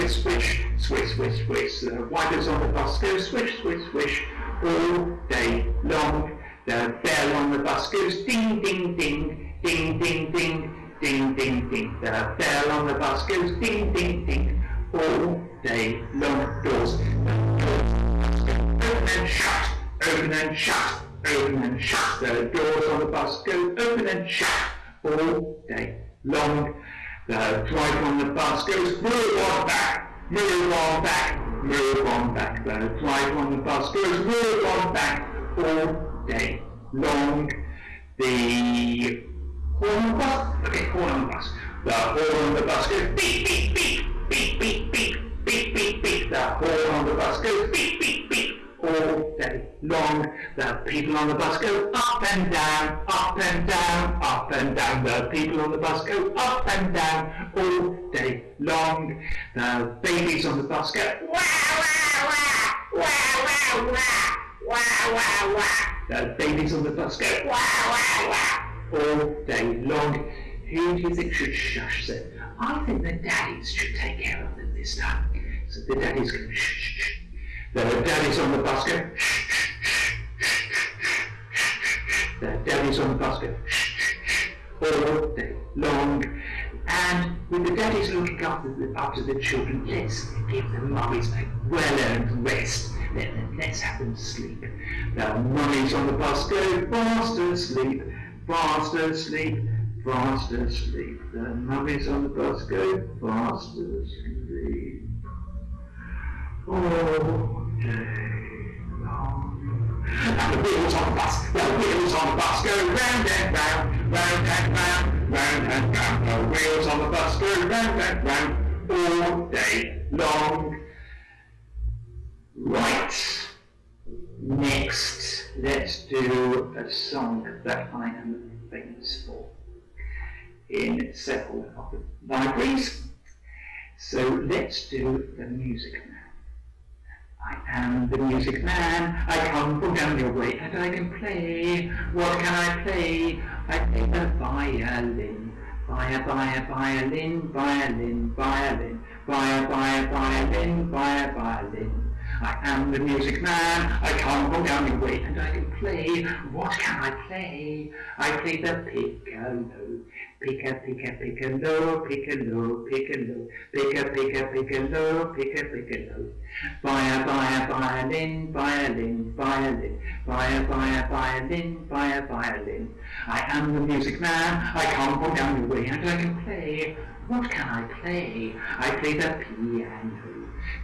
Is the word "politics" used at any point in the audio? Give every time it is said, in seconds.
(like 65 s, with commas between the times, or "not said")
not said.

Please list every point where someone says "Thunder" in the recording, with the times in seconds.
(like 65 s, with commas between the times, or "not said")
not said.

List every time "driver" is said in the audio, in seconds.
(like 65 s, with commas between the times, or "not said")
27 s, 32 s.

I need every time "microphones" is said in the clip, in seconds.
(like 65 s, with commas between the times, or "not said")
not said.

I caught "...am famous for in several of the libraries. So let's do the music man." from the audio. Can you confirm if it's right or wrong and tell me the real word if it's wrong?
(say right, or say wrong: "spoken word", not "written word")
right.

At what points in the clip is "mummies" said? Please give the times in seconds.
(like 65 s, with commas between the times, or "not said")
90 s, 95 s, 101 s.